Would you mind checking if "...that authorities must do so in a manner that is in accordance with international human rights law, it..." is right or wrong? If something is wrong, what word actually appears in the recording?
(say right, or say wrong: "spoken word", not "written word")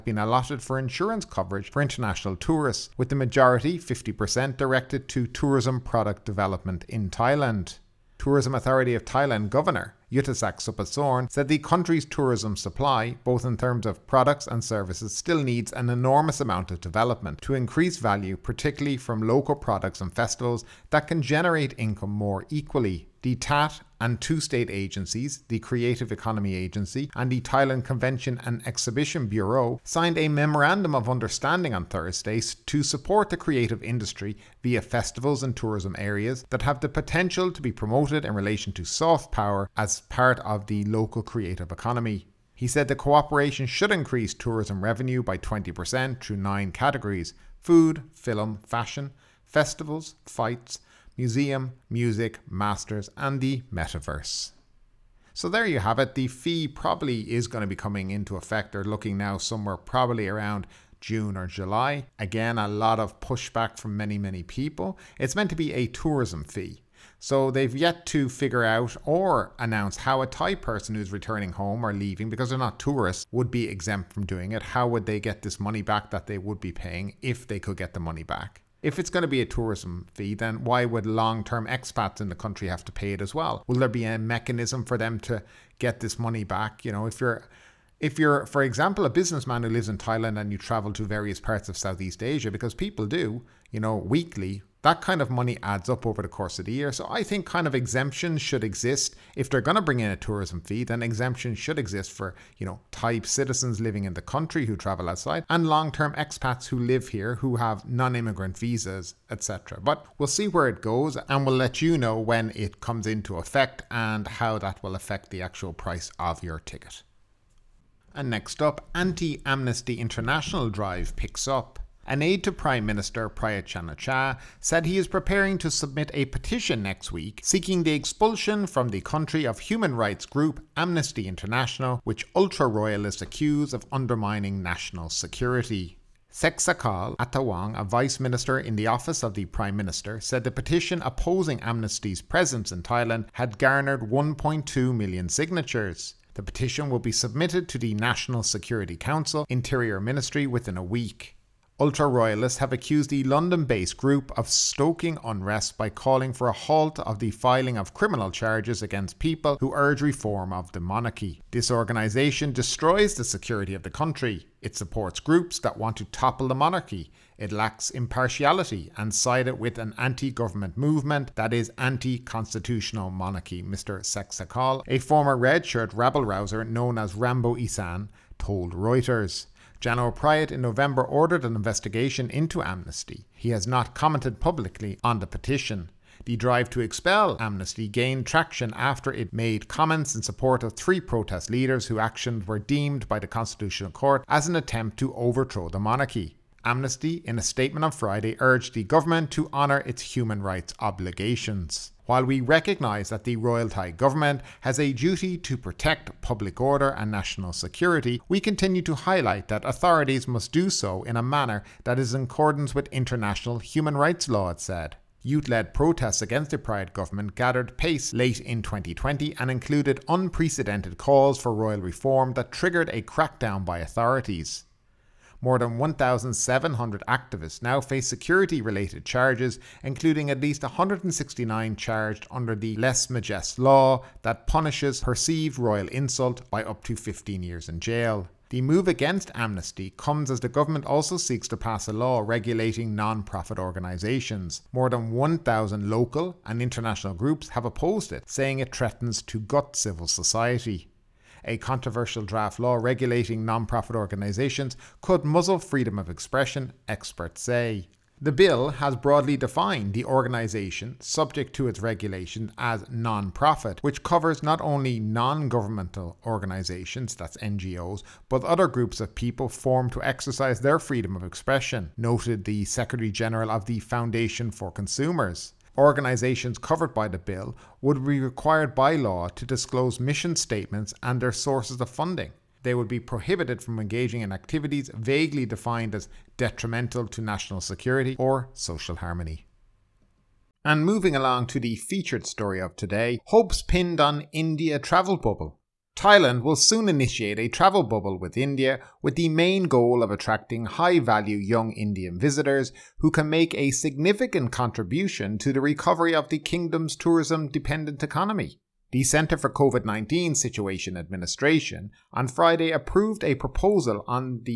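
right.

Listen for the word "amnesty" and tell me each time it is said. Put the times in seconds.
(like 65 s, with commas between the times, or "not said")
119 s, 130 s, 141 s, 182 s, 187 s, 196 s, 239 s.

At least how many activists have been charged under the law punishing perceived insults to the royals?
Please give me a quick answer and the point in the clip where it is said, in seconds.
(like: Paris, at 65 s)
169, at 230 s.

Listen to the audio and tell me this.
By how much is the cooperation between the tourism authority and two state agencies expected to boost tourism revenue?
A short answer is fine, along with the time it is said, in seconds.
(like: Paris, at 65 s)
20%, at 45 s.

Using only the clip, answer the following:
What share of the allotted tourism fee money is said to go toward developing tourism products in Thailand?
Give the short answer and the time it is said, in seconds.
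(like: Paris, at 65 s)
50%, at 3 s.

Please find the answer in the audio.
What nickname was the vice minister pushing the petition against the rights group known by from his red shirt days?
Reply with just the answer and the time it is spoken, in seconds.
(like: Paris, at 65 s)
Rambo Isan, at 177 s.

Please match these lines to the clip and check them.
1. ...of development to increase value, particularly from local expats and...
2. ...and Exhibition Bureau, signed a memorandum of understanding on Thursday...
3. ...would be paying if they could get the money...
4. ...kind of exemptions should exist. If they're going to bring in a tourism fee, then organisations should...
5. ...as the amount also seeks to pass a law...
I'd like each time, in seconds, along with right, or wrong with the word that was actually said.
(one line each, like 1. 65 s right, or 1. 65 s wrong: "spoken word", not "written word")
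1. 16 s wrong: "products", not "expats"
2. 28 s right
3. 76 s right
4. 97 s wrong: "exemptions", not "organisations"
5. 240 s wrong: "government", not "amount".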